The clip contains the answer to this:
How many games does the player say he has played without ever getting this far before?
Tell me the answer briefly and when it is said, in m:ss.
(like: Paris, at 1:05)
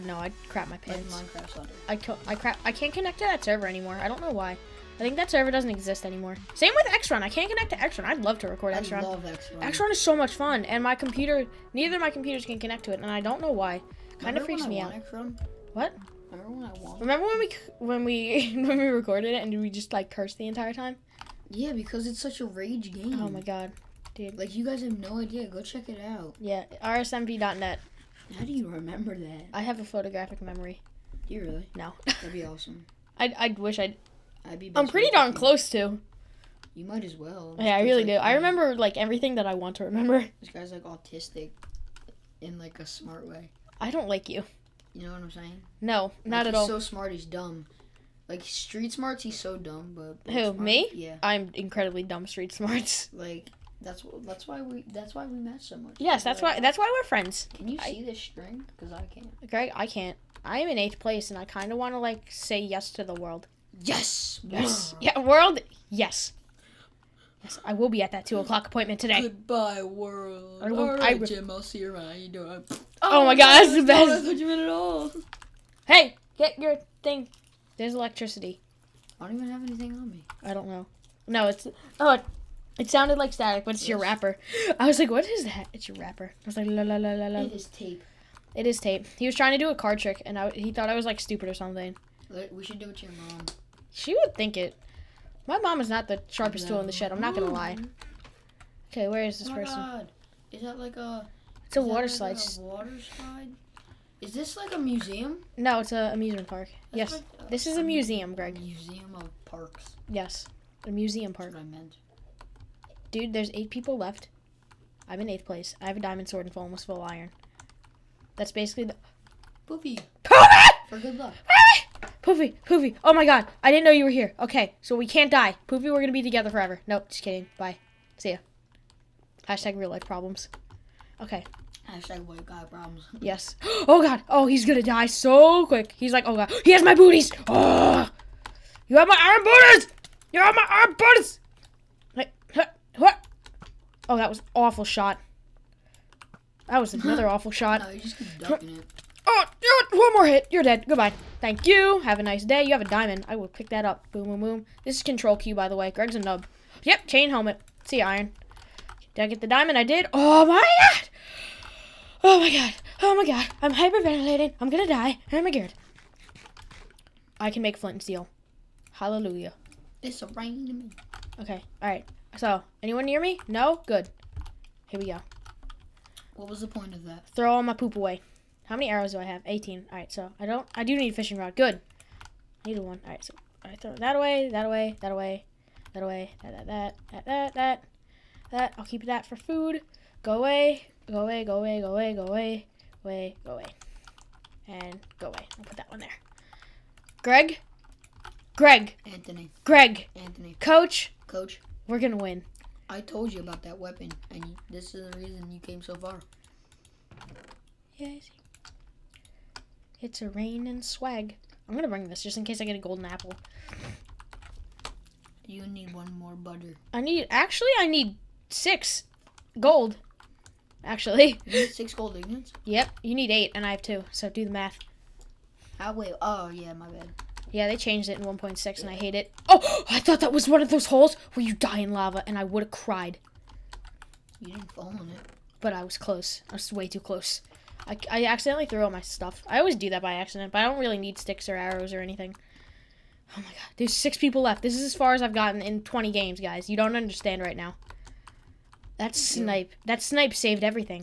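20, at 4:05.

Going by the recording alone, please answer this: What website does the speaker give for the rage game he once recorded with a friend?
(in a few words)
rsmv.net.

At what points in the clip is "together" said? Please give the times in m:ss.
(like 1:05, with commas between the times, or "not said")
2:06.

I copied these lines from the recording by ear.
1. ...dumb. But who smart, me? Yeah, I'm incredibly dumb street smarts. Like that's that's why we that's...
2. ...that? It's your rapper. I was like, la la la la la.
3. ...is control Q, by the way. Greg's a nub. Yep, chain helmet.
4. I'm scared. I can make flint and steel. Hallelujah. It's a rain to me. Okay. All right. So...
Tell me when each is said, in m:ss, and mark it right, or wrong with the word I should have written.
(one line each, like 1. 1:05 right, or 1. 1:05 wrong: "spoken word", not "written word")
1. 0:49 right
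2. 1:25 right
3. 2:34 right
4. 2:45 right.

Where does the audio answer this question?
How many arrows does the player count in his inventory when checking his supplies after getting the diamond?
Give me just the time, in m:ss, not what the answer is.
2:59.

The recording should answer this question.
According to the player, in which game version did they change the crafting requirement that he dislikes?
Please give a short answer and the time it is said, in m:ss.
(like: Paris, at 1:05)
1.6, at 3:48.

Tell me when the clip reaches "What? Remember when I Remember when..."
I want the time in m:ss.
0:15.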